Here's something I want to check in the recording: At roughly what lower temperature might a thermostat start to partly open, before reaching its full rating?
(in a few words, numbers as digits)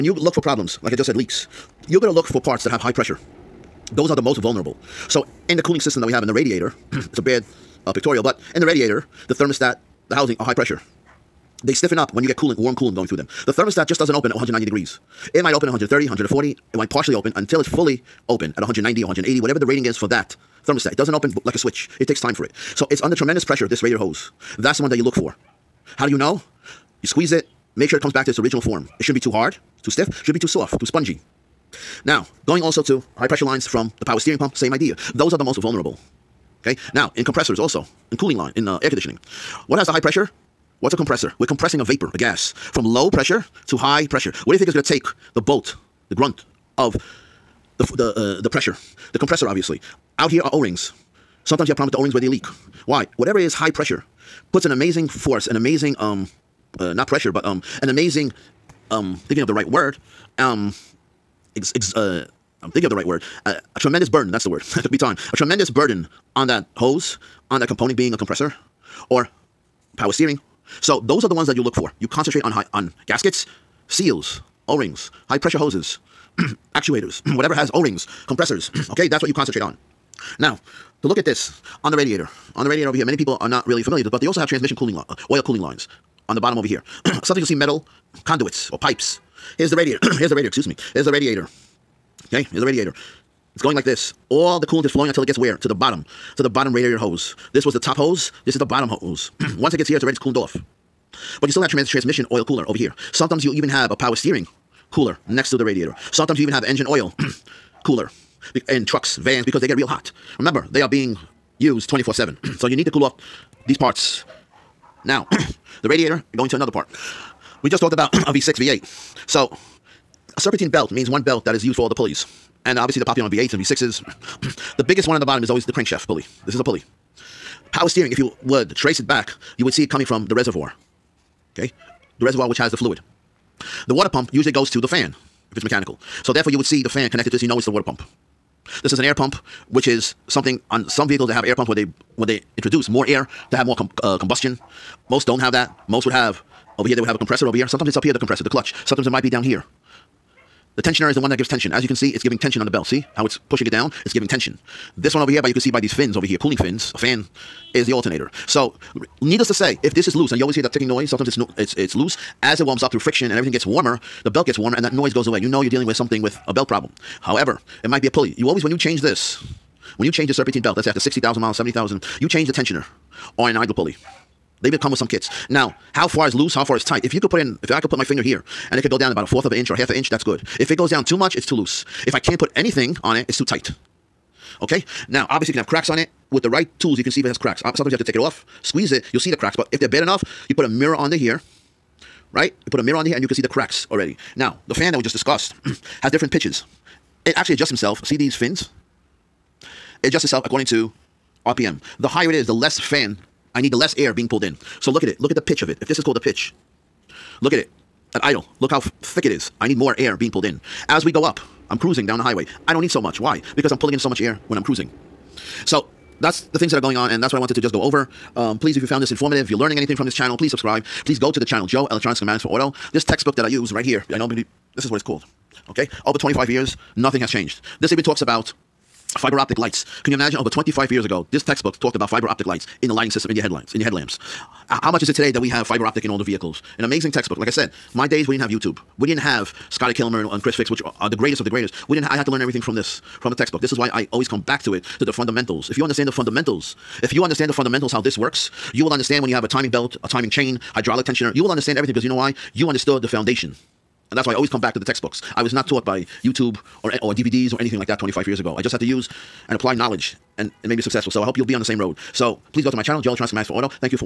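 130.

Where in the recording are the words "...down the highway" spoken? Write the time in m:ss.
3:32.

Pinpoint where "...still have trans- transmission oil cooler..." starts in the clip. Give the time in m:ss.
1:41.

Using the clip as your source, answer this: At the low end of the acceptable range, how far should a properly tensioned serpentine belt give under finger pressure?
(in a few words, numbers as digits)
a fourth of an inch.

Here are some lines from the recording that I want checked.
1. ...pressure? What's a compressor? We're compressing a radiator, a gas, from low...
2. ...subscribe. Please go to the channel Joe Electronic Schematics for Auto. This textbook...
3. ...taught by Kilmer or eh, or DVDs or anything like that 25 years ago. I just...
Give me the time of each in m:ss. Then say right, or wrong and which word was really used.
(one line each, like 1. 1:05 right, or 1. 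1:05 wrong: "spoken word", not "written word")
1. 0:39 wrong: "vapor", not "radiator"
2. 3:40 right
3. 4:15 wrong: "YouTube", not "Kilmer".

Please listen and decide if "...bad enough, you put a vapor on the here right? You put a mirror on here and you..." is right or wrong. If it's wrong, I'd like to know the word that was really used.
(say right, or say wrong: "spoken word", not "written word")
wrong: "mirror", not "vapor".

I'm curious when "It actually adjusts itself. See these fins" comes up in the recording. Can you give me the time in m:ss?
3:17.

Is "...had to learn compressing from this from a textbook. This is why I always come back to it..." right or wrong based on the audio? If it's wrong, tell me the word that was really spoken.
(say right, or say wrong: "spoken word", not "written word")
wrong: "everything", not "compressing".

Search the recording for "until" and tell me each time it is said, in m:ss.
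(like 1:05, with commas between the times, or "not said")
0:17, 1:35.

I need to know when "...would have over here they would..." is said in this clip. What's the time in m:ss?
2:26.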